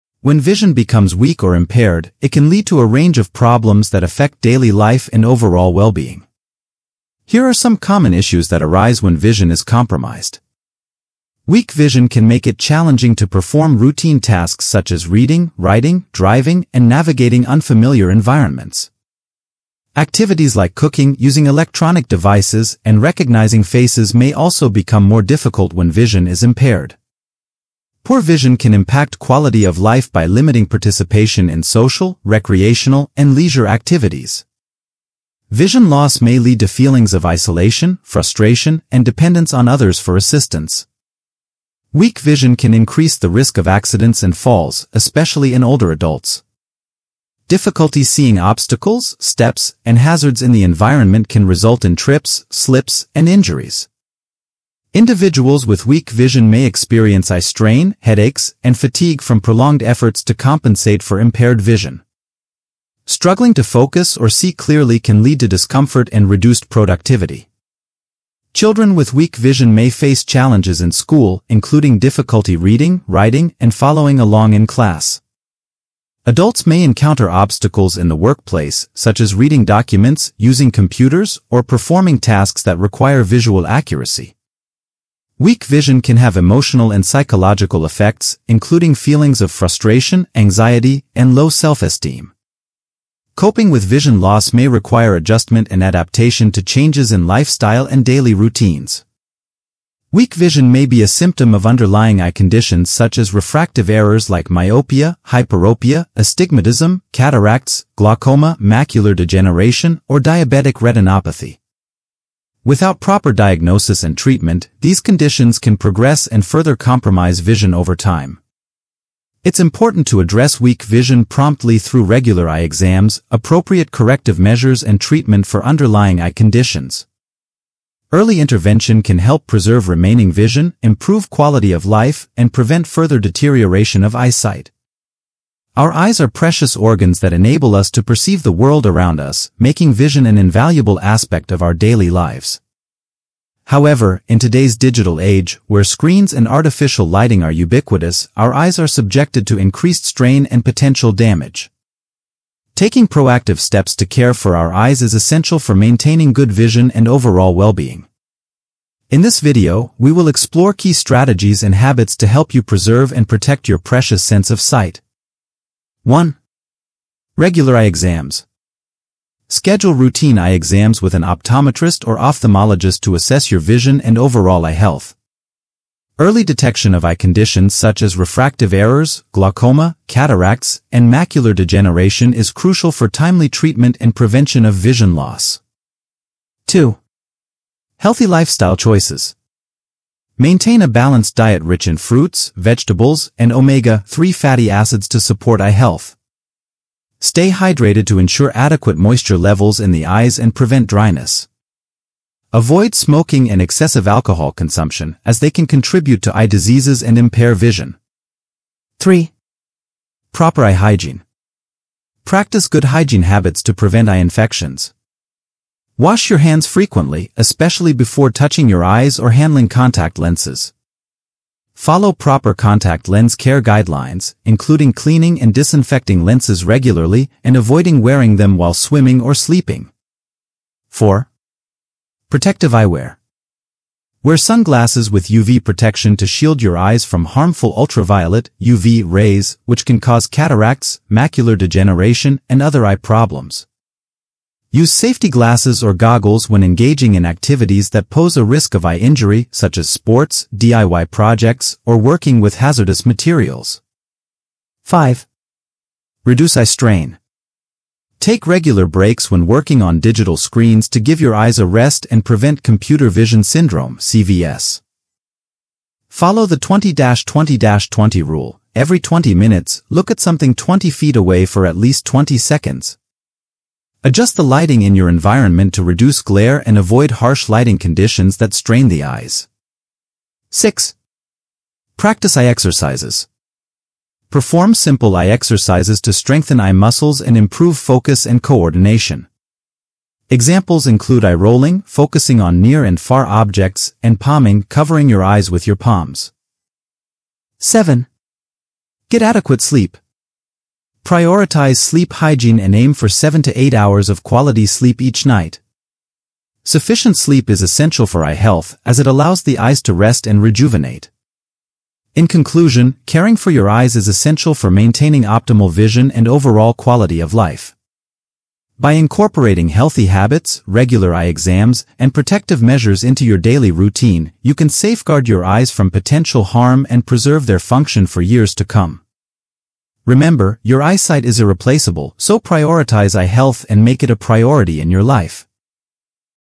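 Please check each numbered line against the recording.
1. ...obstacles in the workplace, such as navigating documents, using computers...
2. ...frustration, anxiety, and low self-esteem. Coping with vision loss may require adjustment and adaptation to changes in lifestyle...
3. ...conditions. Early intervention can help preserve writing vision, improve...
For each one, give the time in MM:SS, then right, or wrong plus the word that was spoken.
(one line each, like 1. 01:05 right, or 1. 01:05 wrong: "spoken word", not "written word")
1. 01:17 wrong: "reading", not "navigating"
2. 01:29 right
3. 02:06 wrong: "remaining", not "writing".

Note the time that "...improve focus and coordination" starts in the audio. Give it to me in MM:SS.
04:47.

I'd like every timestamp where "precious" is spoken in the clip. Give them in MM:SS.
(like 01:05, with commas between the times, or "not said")
02:16, 02:43.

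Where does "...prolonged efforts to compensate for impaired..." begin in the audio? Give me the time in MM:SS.
00:59.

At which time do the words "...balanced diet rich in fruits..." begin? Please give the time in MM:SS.
03:10.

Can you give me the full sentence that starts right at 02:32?
Taking proactive steps to care for our eyes is essential for maintaining good vision and overall well-being.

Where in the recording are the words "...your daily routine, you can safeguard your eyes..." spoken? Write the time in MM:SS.
05:23.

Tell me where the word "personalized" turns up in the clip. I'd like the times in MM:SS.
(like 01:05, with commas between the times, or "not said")
not said.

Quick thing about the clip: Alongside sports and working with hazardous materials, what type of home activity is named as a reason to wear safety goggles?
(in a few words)
DIY projects.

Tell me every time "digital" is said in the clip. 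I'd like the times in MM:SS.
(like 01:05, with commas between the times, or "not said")
02:24, 04:19.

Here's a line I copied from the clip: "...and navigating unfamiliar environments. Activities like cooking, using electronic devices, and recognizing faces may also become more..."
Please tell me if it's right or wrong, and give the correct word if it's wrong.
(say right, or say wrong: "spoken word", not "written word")
right.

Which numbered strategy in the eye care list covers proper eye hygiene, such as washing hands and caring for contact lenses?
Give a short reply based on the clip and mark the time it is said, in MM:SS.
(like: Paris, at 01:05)
3, at 03:28.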